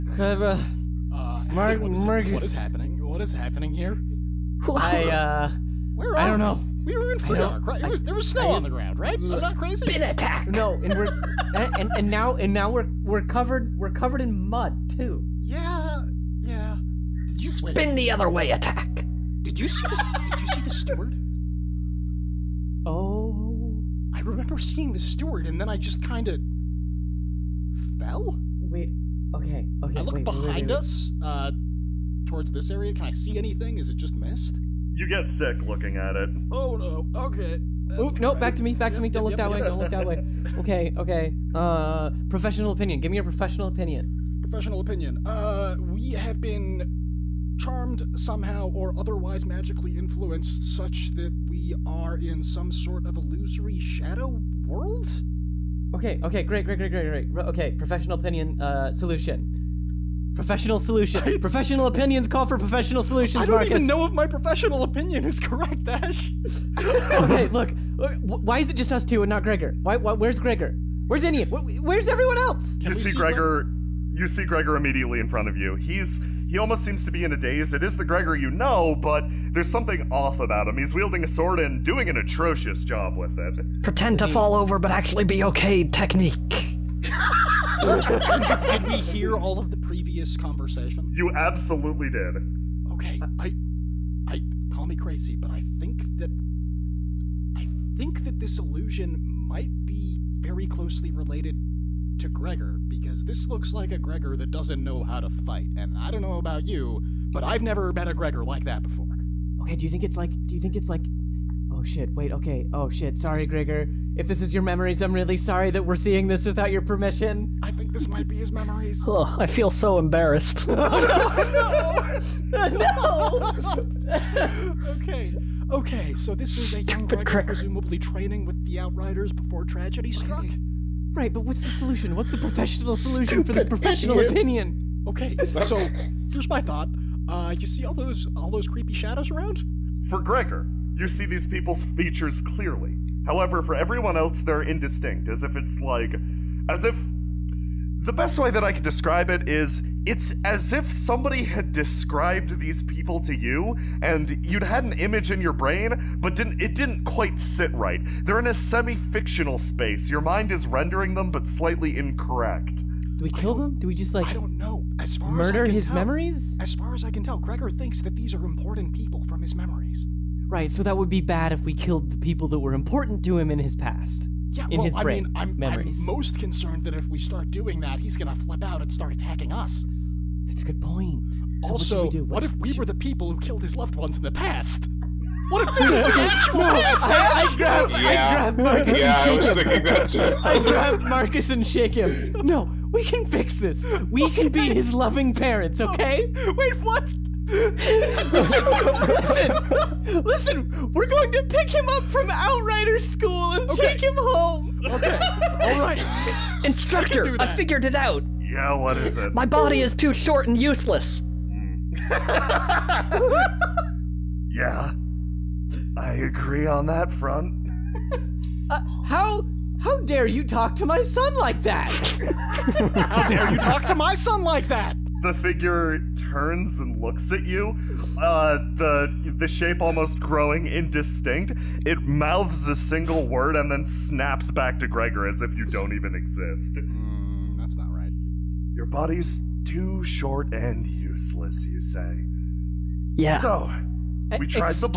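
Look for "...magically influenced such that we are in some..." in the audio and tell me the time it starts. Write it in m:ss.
0:49.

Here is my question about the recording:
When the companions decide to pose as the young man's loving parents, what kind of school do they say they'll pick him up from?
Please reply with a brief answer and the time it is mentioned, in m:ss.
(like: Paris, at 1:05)
Outrider School, at 3:22.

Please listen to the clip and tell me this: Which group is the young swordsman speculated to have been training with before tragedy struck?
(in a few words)
the Outriders.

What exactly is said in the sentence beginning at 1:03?
even know if my professional opinion is correct, Ash.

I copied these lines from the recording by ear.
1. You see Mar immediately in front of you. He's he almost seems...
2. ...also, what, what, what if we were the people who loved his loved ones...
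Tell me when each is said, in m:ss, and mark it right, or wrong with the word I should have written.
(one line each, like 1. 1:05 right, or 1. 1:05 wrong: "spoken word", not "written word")
1. 1:14 wrong: "Gregor", not "Mar"
2. 3:01 wrong: "killed", not "loved".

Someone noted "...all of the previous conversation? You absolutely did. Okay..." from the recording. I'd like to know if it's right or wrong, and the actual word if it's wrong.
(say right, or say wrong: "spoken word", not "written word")
right.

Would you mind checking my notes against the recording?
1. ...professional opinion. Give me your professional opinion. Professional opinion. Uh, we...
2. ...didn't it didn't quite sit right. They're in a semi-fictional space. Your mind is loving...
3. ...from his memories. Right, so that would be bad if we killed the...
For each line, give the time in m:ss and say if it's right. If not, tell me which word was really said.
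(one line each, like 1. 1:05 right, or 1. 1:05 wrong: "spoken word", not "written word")
1. 0:42 right
2. 2:36 wrong: "rendering", not "loving"
3. 2:49 right.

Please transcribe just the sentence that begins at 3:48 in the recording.
Uh, the the shape almost growing indistinct.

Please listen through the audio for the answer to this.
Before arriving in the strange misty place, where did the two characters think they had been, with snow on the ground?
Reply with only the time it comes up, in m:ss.
0:07.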